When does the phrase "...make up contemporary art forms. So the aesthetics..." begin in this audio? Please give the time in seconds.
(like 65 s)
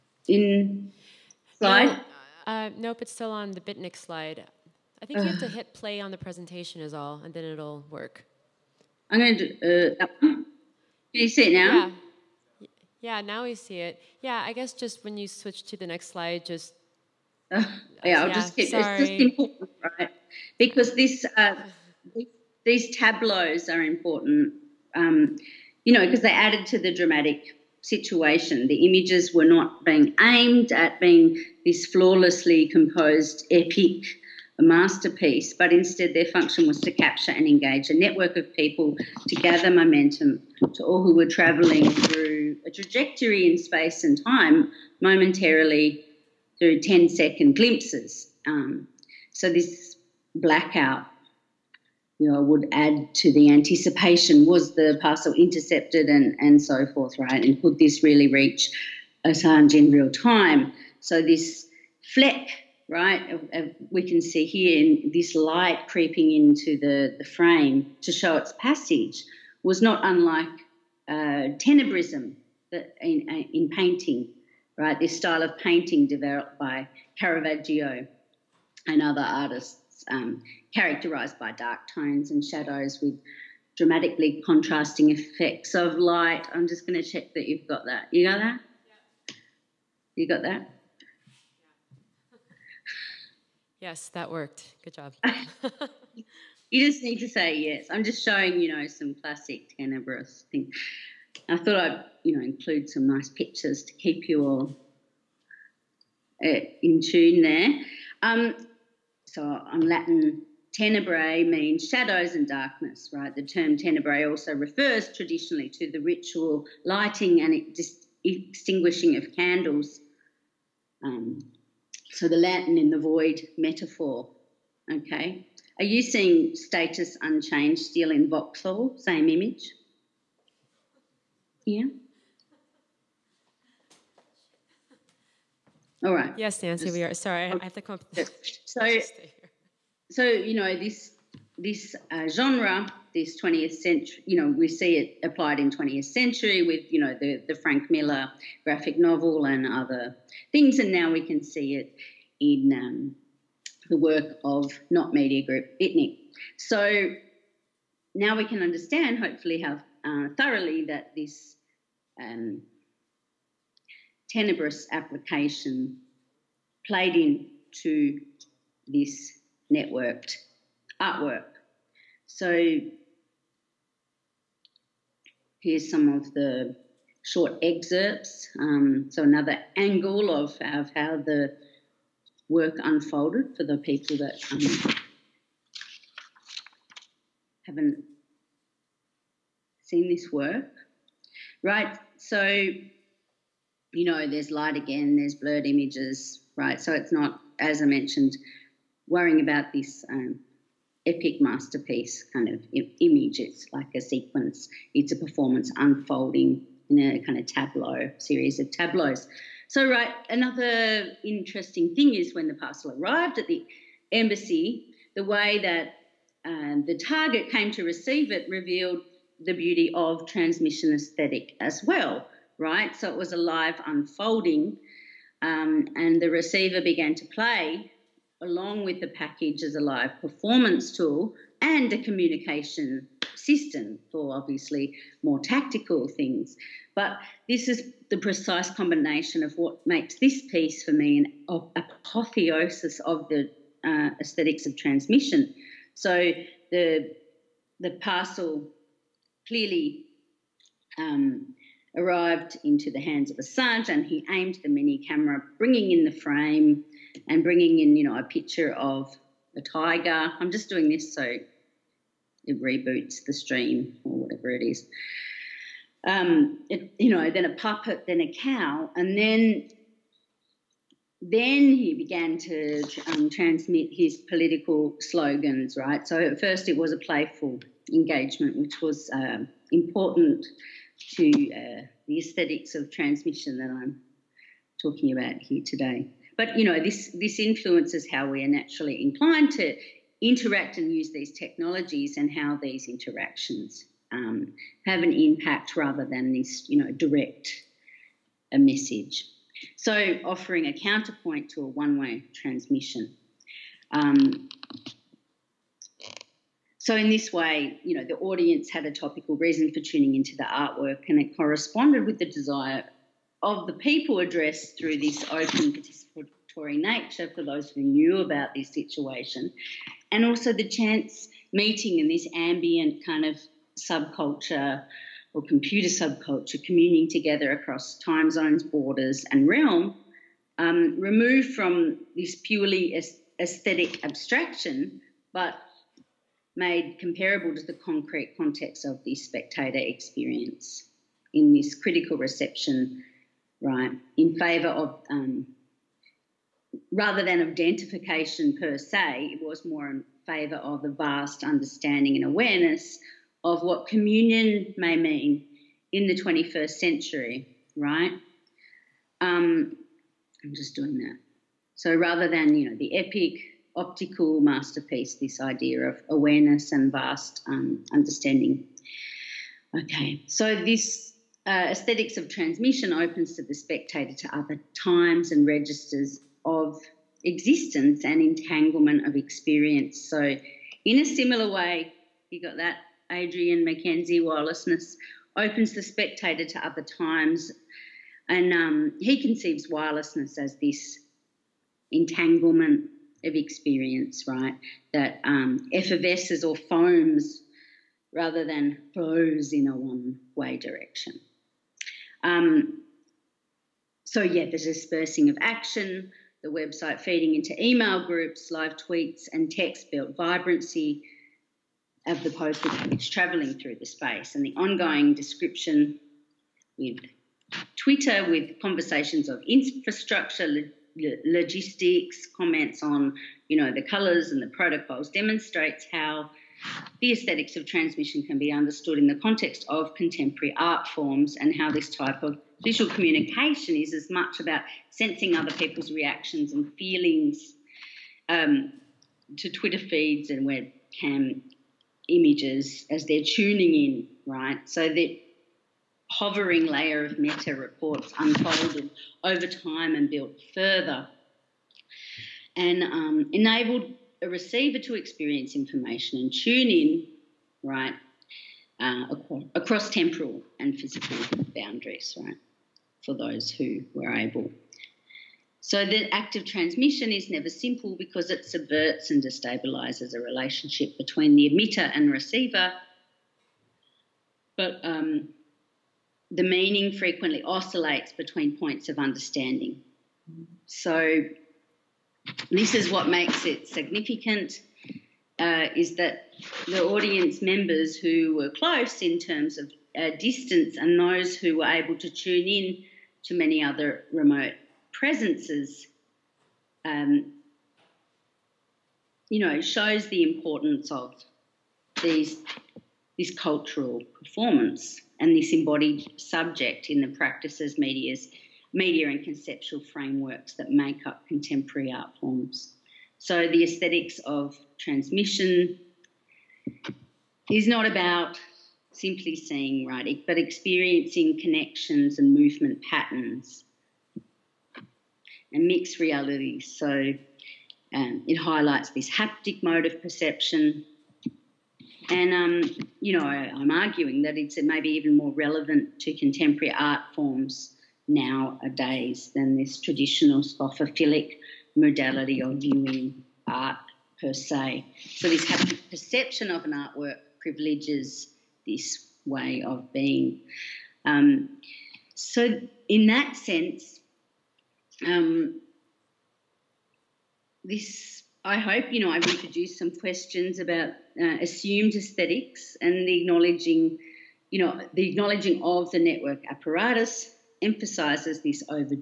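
510 s.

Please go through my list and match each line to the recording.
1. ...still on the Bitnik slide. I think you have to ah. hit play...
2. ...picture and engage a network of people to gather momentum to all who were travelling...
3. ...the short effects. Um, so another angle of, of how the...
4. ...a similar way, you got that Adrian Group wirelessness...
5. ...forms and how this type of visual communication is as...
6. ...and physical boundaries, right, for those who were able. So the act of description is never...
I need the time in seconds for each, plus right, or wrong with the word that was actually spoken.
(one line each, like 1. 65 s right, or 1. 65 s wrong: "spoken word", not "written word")
1. 3 s right
2. 36 s wrong: "capture", not "picture"
3. 176 s wrong: "excerpts", not "effects"
4. 380 s wrong: "Mackenzie", not "Group"
5. 430 s right
6. 460 s wrong: "transmission", not "description".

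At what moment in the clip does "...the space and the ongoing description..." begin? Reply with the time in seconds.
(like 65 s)
413 s.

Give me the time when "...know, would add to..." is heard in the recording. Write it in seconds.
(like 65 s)
52 s.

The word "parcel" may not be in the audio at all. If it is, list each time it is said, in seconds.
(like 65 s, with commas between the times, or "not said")
55 s, 212 s, 248 s.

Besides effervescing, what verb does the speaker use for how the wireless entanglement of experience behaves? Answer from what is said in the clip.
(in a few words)
foams.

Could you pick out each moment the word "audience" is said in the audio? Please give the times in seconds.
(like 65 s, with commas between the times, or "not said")
308 s, 486 s.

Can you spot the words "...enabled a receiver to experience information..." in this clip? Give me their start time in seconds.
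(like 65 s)
453 s.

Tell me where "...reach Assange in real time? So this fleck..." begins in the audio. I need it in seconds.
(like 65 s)
58 s.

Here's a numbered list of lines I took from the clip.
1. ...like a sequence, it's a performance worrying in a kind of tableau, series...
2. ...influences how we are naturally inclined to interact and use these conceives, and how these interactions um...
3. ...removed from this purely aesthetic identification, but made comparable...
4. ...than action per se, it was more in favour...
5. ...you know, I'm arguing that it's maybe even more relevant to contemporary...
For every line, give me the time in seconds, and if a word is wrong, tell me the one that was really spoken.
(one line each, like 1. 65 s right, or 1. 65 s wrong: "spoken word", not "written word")
1. 203 s wrong: "unfolding", not "worrying"
2. 287 s wrong: "technologies", not "conceives"
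3. 330 s wrong: "abstraction", not "identification"
4. 347 s wrong: "identification", not "action"
5. 532 s right.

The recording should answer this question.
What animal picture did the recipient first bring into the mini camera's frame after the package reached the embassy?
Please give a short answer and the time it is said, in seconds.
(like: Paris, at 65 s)
a tiger, at 259 s.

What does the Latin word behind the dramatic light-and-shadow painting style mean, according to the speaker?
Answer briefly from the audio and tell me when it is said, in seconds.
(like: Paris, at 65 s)
shadows and darkness, at 111 s.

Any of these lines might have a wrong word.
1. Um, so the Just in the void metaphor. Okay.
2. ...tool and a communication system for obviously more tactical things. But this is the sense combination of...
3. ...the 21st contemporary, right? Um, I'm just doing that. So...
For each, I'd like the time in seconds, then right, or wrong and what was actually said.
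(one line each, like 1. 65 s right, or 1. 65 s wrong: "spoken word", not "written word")
1. 121 s wrong: "Latin", not "Just"
2. 230 s wrong: "precise", not "sense"
3. 356 s wrong: "century", not "contemporary".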